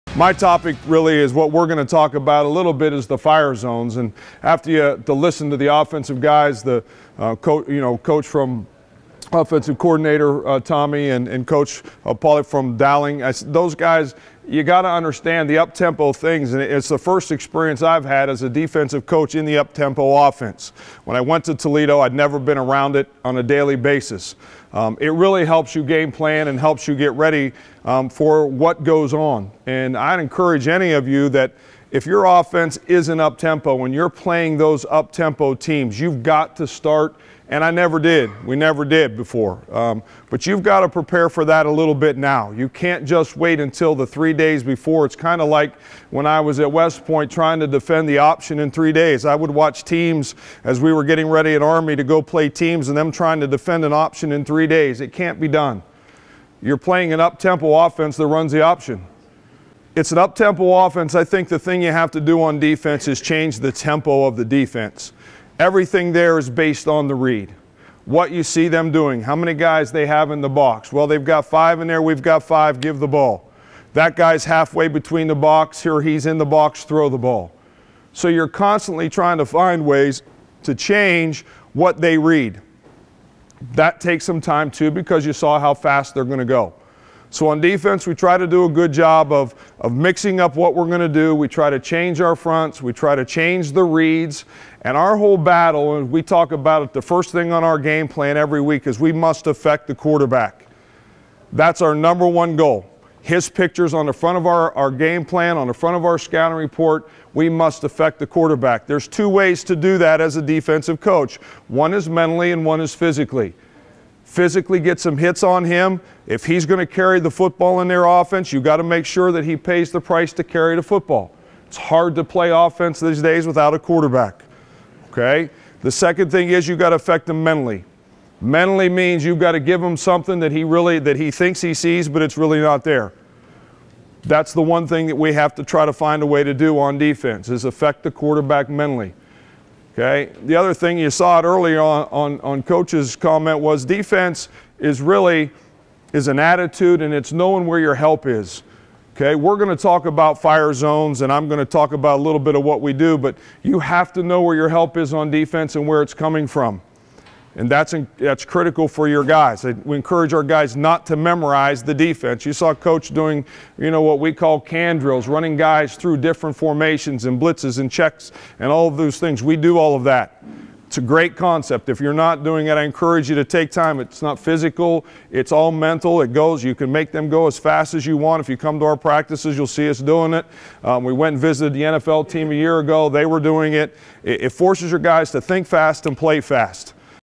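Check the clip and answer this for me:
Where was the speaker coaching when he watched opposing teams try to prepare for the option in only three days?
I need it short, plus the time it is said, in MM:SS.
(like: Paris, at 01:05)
West Point, at 00:46.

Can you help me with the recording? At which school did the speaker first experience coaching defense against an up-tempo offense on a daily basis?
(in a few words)
Toledo.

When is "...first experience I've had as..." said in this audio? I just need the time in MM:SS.
00:16.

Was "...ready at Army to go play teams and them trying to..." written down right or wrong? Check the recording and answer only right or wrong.
right.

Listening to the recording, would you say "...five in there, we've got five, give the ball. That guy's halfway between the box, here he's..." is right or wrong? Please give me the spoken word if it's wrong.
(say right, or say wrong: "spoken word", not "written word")
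right.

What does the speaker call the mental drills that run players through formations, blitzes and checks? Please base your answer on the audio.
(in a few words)
Can drills.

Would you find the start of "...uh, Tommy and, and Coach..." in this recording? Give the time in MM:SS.
00:10.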